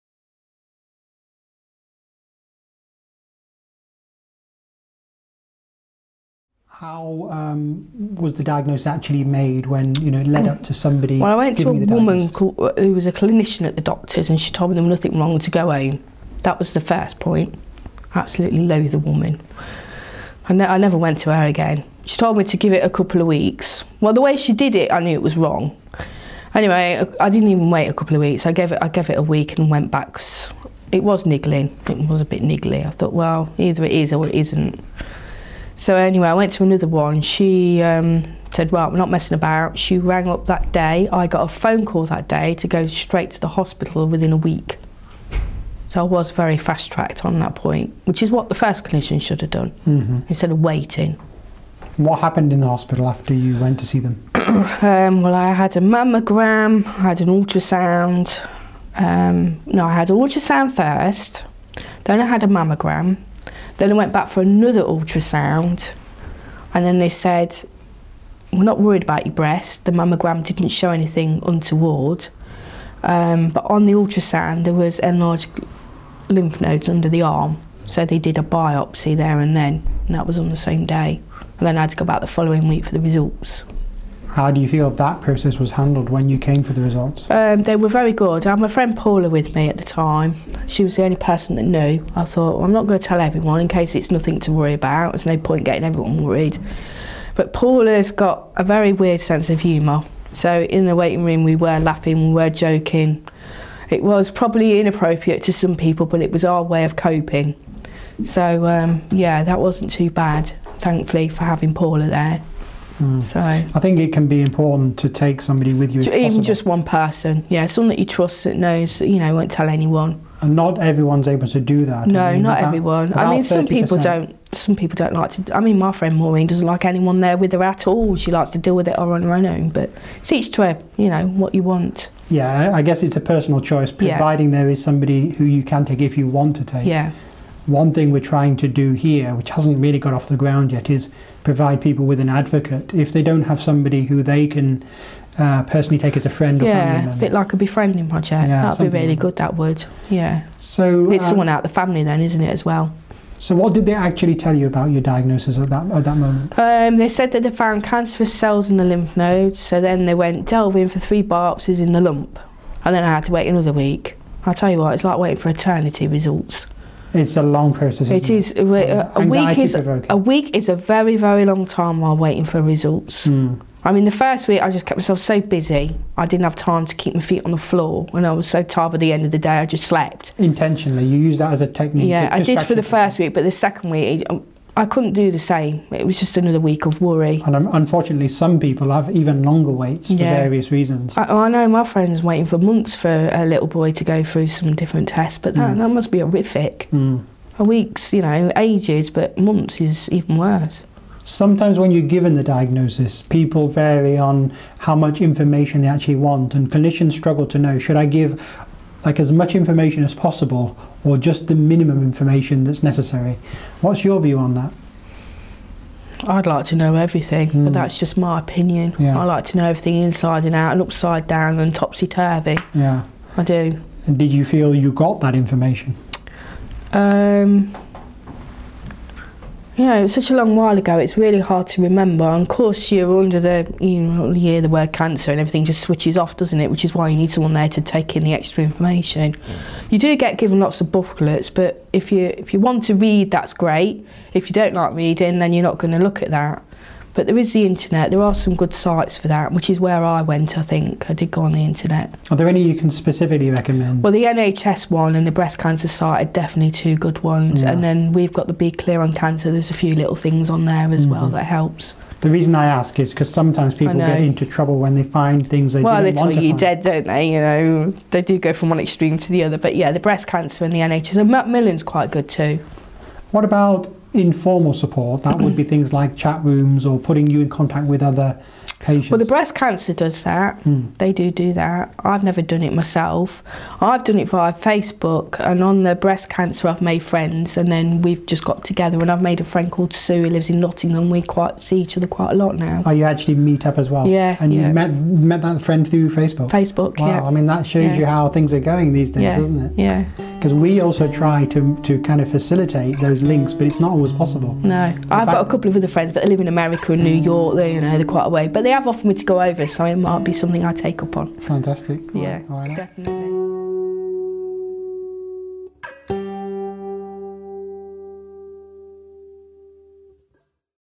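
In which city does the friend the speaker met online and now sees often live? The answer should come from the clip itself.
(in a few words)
Nottingham.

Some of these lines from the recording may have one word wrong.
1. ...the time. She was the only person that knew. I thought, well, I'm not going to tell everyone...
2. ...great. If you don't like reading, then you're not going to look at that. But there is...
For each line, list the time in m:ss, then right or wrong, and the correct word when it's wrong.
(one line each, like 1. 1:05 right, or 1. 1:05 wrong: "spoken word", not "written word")
1. 1:29 right
2. 4:03 right.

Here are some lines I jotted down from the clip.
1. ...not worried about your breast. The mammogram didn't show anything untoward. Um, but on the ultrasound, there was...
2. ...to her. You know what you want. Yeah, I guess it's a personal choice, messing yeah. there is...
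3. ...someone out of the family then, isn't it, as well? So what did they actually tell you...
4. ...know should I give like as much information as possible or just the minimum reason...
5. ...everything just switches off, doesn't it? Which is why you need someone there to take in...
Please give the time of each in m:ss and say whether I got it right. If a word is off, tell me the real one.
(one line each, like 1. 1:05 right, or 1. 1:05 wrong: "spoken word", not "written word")
1. 1:08 right
2. 2:10 wrong: "providing", not "messing"
3. 2:31 right
4. 3:27 wrong: "information", not "reason"
5. 3:55 right.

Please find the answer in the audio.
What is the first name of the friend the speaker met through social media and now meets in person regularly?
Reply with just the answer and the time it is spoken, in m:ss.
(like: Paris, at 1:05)
Sue, at 4:49.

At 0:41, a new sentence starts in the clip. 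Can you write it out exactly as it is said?
I got a phone call that day to go straight to the hospital within a week.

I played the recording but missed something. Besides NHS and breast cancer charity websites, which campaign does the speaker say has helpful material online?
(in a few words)
Be Clear on Cancer.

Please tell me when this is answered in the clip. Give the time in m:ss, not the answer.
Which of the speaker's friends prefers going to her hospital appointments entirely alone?
2:06.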